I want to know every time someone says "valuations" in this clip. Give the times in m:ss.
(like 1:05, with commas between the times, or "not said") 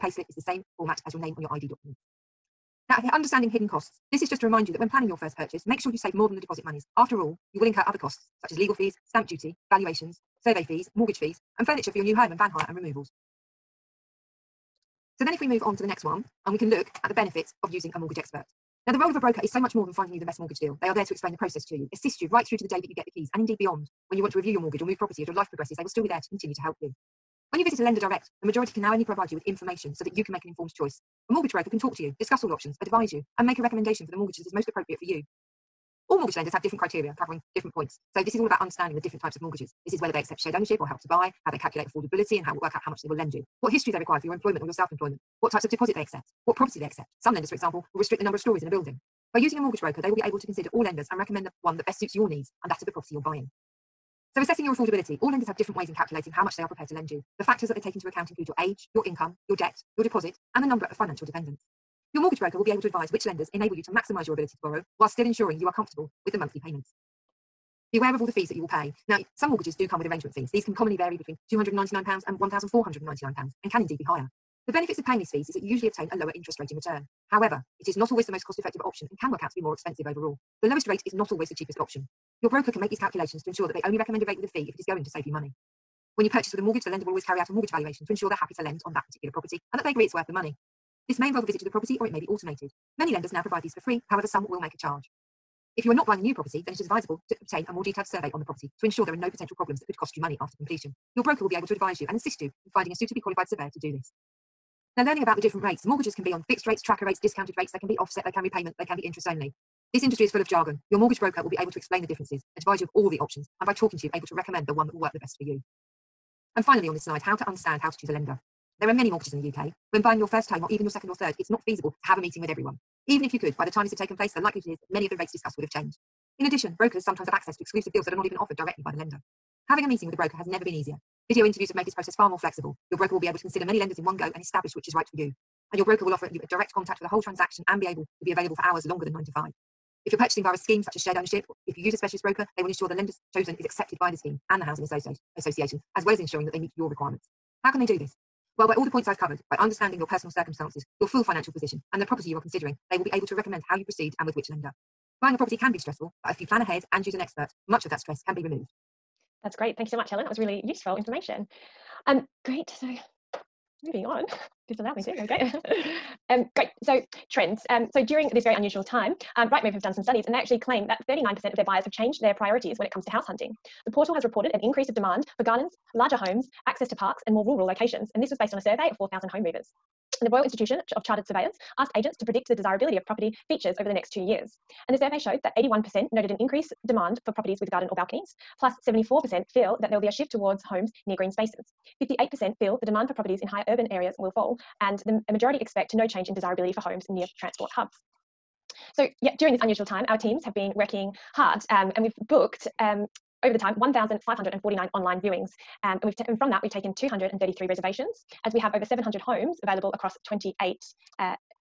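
0:09, 1:27.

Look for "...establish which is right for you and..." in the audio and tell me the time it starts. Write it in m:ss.
2:14.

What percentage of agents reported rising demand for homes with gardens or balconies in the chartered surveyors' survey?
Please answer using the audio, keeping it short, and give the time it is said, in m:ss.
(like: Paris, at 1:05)
81%, at 3:05.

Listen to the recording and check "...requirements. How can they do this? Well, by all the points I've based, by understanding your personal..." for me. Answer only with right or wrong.
wrong.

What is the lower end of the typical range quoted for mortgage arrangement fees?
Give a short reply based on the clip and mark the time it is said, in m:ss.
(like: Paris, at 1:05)
£299, at 1:11.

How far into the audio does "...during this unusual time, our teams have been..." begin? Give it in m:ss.
3:19.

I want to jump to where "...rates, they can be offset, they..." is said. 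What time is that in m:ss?
1:47.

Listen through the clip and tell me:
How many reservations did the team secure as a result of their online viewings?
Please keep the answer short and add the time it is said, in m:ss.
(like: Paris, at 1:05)
233, at 3:26.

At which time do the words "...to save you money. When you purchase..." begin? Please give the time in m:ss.
1:25.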